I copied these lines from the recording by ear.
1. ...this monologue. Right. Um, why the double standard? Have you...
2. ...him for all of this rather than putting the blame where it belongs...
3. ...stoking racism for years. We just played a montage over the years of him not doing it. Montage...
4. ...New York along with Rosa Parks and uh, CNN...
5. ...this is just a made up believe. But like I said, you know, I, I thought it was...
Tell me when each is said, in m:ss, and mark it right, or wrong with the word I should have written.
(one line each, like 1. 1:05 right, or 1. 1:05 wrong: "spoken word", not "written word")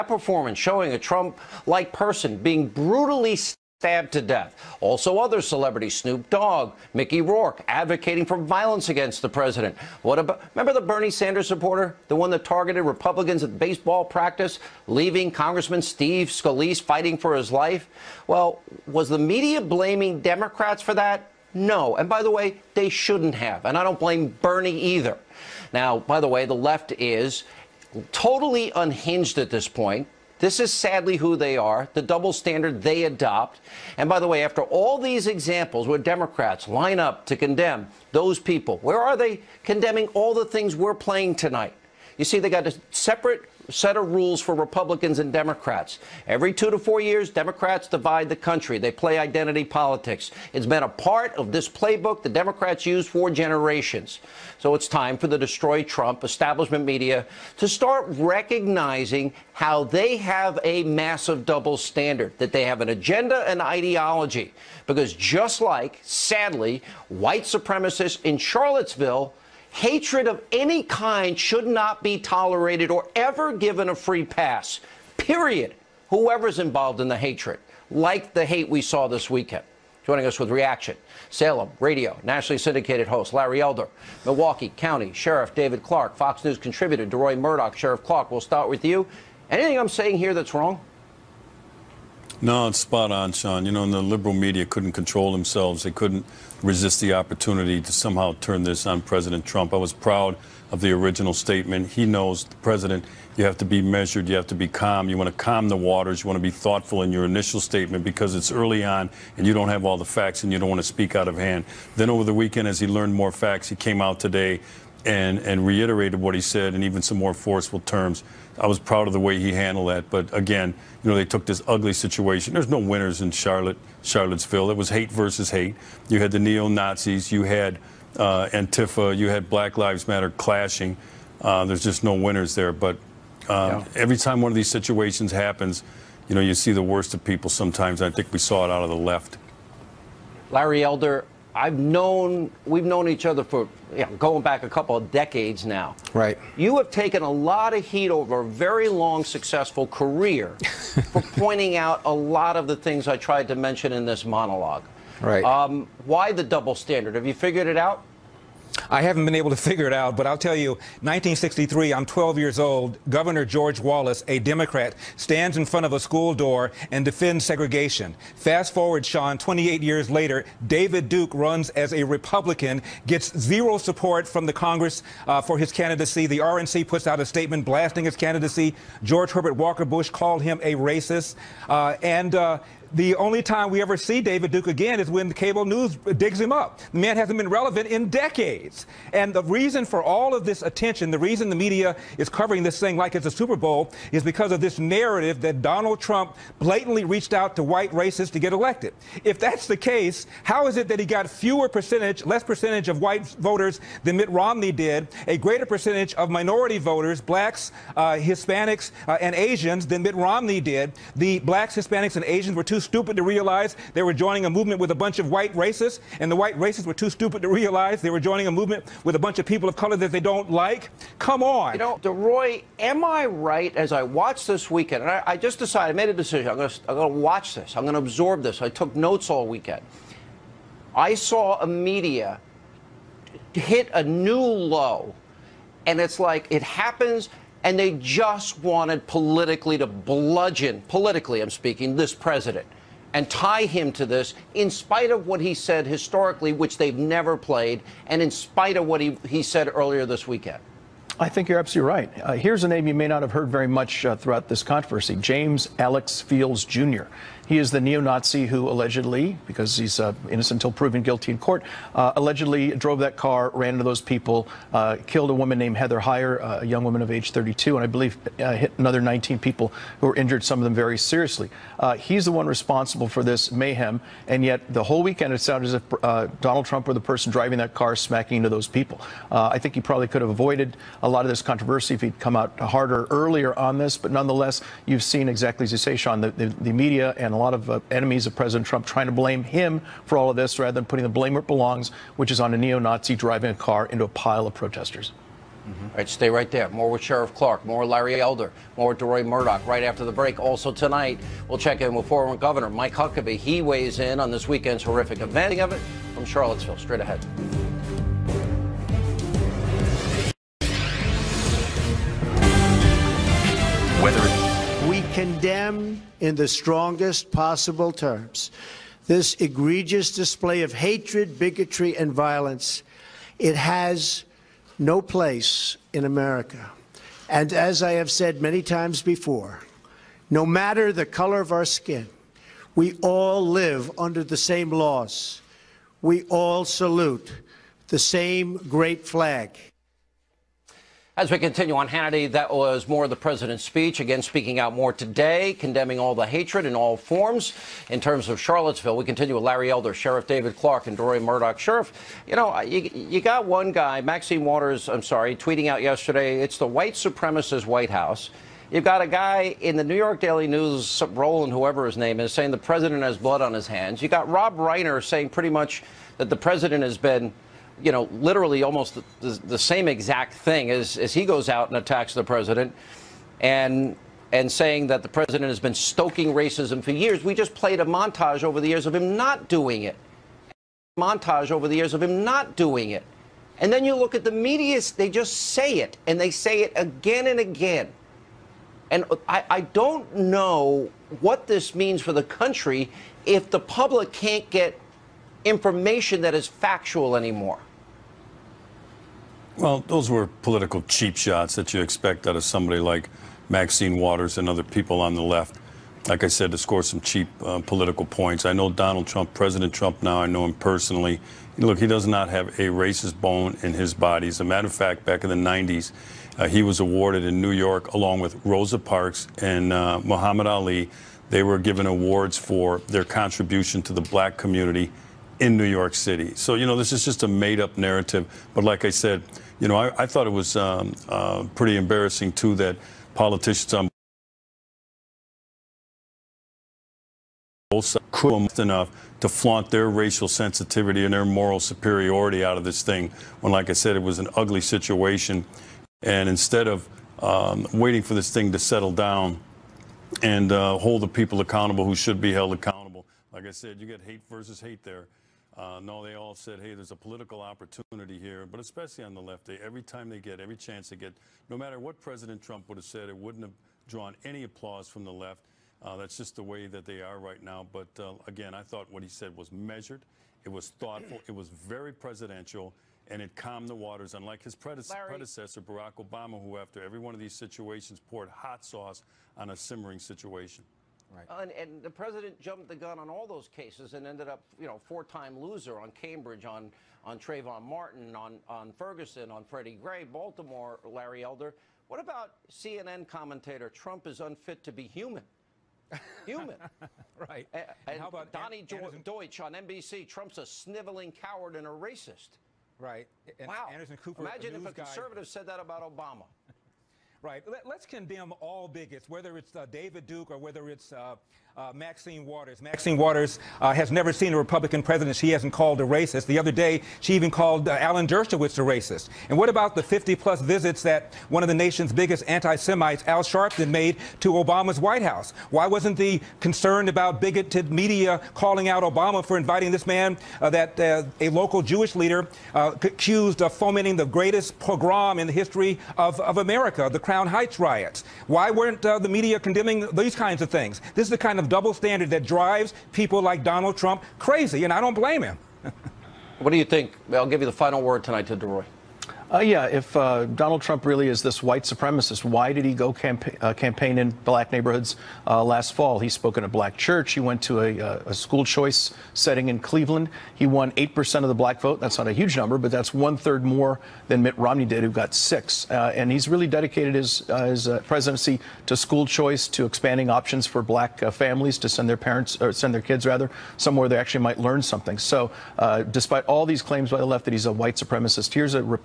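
1. 2:34 right
2. 4:49 right
3. 6:15 right
4. 6:57 wrong: "Muhammad", not "CNN"
5. 7:06 wrong: "narrative", not "believe".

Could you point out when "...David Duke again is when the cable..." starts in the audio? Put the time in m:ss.
3:04.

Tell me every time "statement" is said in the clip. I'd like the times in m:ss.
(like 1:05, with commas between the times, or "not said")
1:41, 1:47, 2:57.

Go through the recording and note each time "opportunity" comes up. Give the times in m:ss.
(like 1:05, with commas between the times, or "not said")
1:37, 7:37.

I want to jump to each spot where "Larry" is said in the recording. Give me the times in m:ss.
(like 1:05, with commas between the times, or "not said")
1:23, 2:20, 4:57, 5:49, 7:54, 8:10.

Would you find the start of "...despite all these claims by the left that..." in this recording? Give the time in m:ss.
9:35.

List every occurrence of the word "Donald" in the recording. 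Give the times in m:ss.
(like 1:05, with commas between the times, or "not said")
3:15, 4:36, 6:48, 9:03, 9:10.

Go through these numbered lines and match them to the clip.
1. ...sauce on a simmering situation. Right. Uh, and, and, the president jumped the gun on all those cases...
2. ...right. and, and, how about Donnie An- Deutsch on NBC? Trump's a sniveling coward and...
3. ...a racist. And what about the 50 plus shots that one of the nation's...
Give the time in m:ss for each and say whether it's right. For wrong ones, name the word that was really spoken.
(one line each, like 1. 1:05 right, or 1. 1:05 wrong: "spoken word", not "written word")
1. 7:58 right
2. 8:17 right
3. 8:38 wrong: "visits", not "shots".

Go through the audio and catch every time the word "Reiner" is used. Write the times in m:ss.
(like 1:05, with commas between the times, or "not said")
6:04.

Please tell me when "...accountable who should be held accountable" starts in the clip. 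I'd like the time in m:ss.
7:31.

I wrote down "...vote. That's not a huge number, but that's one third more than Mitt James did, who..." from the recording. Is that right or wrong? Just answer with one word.
wrong.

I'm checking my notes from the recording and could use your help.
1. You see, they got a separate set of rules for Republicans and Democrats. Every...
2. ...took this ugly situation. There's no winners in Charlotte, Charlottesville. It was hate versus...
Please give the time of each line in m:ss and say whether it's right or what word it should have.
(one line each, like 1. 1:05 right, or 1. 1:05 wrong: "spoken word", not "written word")
1. 0:42 right
2. 2:01 right.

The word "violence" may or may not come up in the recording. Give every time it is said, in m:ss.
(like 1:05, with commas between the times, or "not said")
0:08, 5:22.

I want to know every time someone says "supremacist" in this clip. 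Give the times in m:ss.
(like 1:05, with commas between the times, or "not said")
1:07, 5:56, 9:11, 9:37.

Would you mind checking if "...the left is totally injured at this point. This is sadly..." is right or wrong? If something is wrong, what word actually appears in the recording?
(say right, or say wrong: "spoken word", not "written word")
wrong: "unhinged", not "injured".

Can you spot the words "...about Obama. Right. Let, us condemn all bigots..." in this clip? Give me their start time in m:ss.
8:25.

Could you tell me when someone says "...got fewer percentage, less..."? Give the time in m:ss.
3:21.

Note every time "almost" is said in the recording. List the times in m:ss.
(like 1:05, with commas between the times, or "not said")
6:08.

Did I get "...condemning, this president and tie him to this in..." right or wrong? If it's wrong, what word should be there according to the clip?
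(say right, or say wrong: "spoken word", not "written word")
wrong: "speaking", not "condemning".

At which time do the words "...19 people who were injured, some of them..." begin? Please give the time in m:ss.
4:29.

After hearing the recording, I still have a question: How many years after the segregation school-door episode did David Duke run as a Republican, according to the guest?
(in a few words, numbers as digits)
28.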